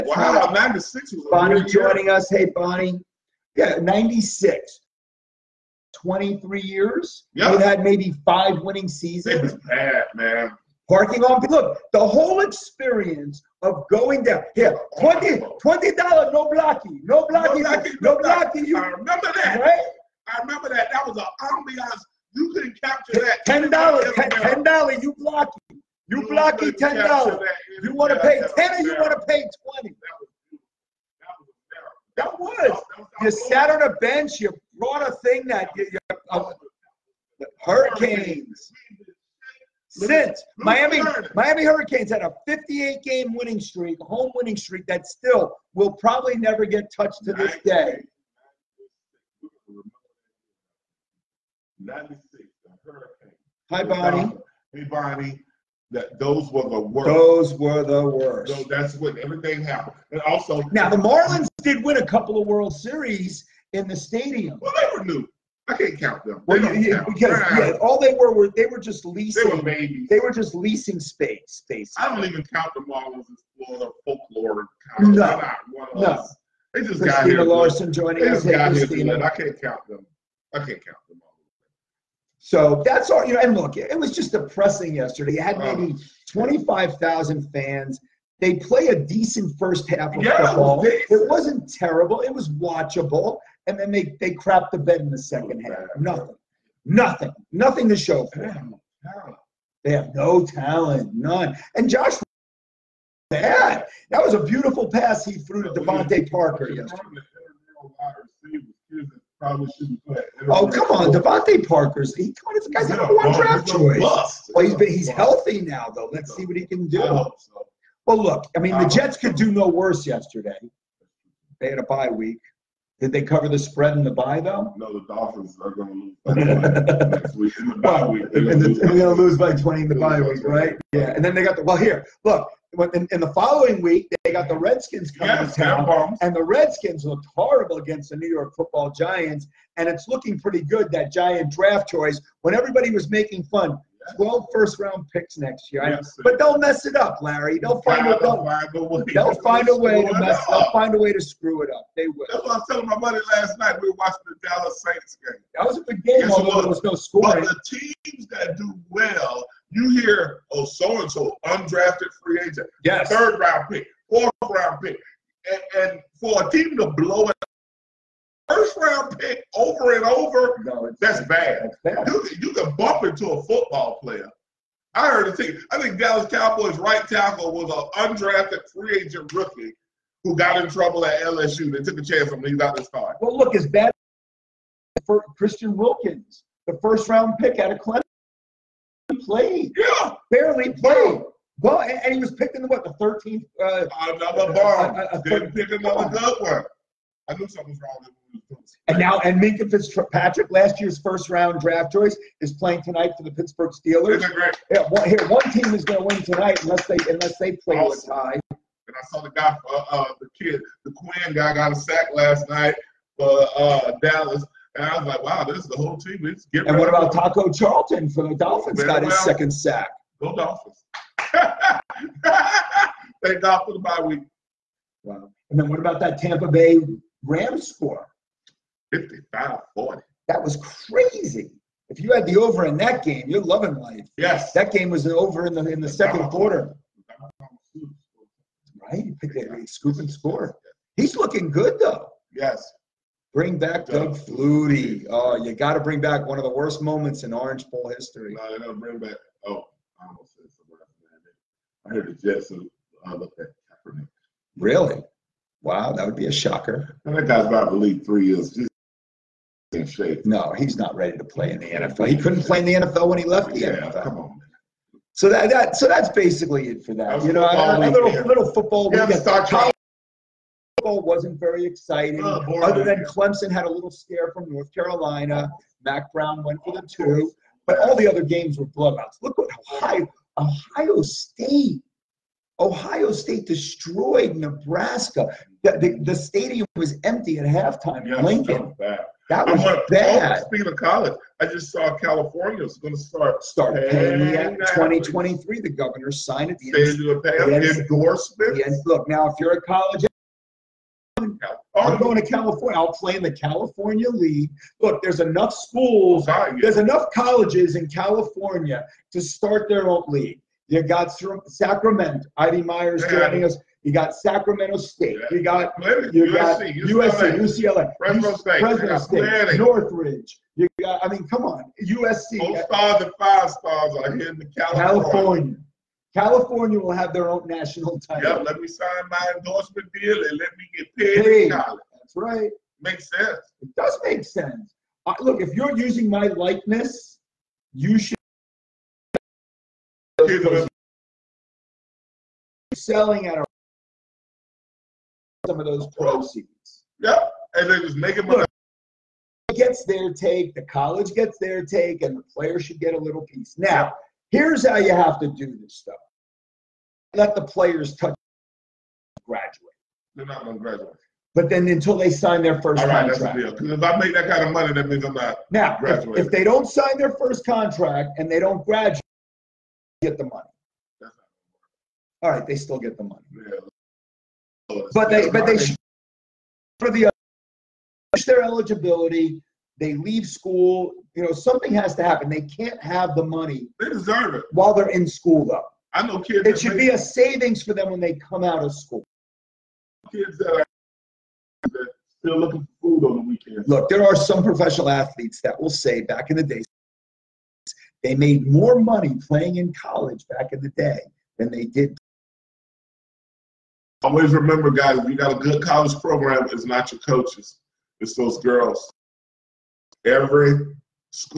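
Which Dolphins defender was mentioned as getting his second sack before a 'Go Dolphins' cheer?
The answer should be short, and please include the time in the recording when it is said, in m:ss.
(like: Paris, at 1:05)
Taco Charlton, at 3:37.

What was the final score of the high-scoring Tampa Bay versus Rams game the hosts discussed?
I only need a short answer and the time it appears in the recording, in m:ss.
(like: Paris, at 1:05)
55-40, at 3:48.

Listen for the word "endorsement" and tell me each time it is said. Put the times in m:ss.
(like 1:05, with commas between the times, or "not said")
4:57, 5:29.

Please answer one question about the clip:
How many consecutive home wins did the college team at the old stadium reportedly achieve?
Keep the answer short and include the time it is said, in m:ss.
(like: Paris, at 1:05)
58, at 0:42.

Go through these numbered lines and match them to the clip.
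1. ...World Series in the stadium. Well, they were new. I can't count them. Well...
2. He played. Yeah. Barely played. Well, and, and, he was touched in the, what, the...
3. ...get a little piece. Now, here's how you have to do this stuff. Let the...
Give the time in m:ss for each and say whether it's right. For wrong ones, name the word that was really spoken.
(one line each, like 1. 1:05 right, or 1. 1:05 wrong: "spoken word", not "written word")
1. 1:02 right
2. 3:09 wrong: "picked", not "touched"
3. 5:52 right.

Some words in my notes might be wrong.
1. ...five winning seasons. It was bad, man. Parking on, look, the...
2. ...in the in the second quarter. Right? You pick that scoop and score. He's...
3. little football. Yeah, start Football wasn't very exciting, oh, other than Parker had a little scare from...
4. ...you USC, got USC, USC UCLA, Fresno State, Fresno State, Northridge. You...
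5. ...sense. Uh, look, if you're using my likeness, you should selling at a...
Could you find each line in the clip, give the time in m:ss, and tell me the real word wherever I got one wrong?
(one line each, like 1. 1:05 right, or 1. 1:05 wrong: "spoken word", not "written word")
1. 0:08 right
2. 3:55 right
3. 4:28 wrong: "Clemson", not "Parker"
4. 5:16 right
5. 5:34 right.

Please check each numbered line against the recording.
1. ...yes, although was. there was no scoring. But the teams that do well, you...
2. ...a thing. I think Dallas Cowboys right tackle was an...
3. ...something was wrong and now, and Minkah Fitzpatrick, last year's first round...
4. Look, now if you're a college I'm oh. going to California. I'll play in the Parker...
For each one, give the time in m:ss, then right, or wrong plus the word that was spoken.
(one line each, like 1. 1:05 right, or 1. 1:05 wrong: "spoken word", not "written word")
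1. 2:36 right
2. 2:55 right
3. 3:17 right
4. 4:58 wrong: "California", not "Parker".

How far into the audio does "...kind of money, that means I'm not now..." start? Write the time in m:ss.
6:04.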